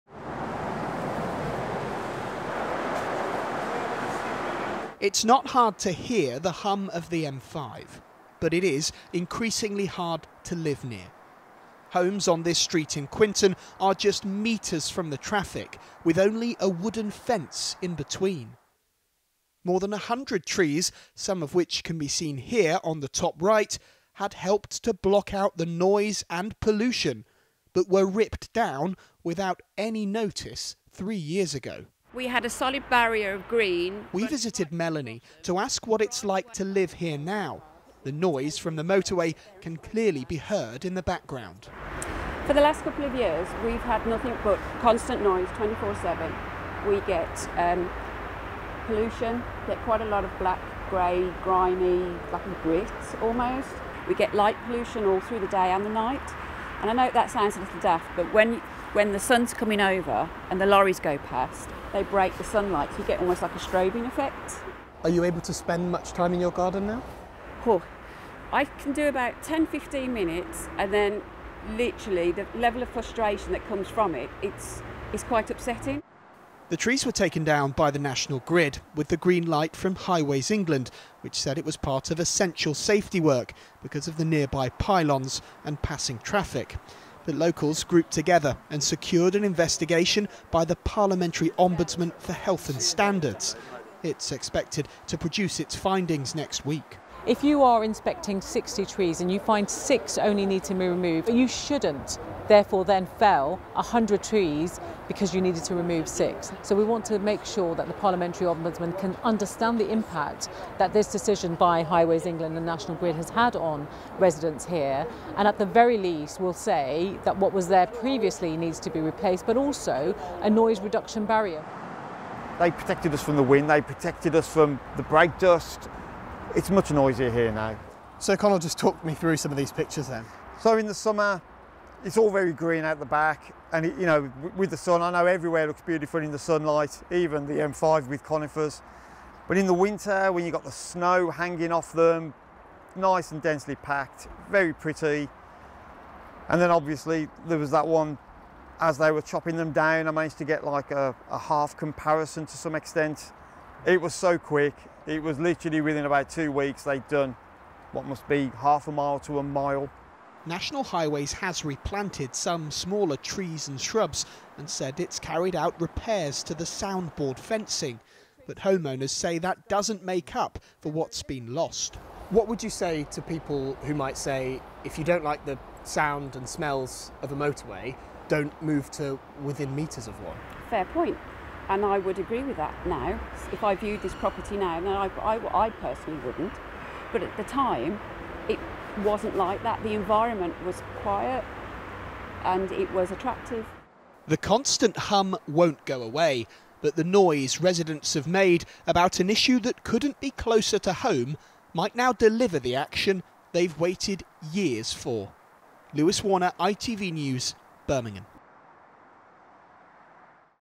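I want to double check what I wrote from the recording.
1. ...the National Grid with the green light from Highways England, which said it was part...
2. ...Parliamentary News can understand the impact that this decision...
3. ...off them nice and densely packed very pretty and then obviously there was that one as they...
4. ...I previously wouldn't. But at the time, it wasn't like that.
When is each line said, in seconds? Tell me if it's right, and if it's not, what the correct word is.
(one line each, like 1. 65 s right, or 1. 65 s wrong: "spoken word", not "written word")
1. 77 s right
2. 107 s wrong: "Ombudsman", not "News"
3. 141 s right
4. 185 s wrong: "personally", not "previously".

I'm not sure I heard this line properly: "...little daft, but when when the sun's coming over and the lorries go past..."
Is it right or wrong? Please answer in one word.
right.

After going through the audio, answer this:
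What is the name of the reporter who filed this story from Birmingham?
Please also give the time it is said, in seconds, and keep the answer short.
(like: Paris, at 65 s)
Lewis Warner, at 205 s.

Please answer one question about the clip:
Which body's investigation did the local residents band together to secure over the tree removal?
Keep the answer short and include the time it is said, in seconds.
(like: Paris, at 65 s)
Parliamentary Ombudsman for Health and Standards, at 90 s.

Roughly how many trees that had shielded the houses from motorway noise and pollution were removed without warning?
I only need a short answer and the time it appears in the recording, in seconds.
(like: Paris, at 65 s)
More than 100, at 19 s.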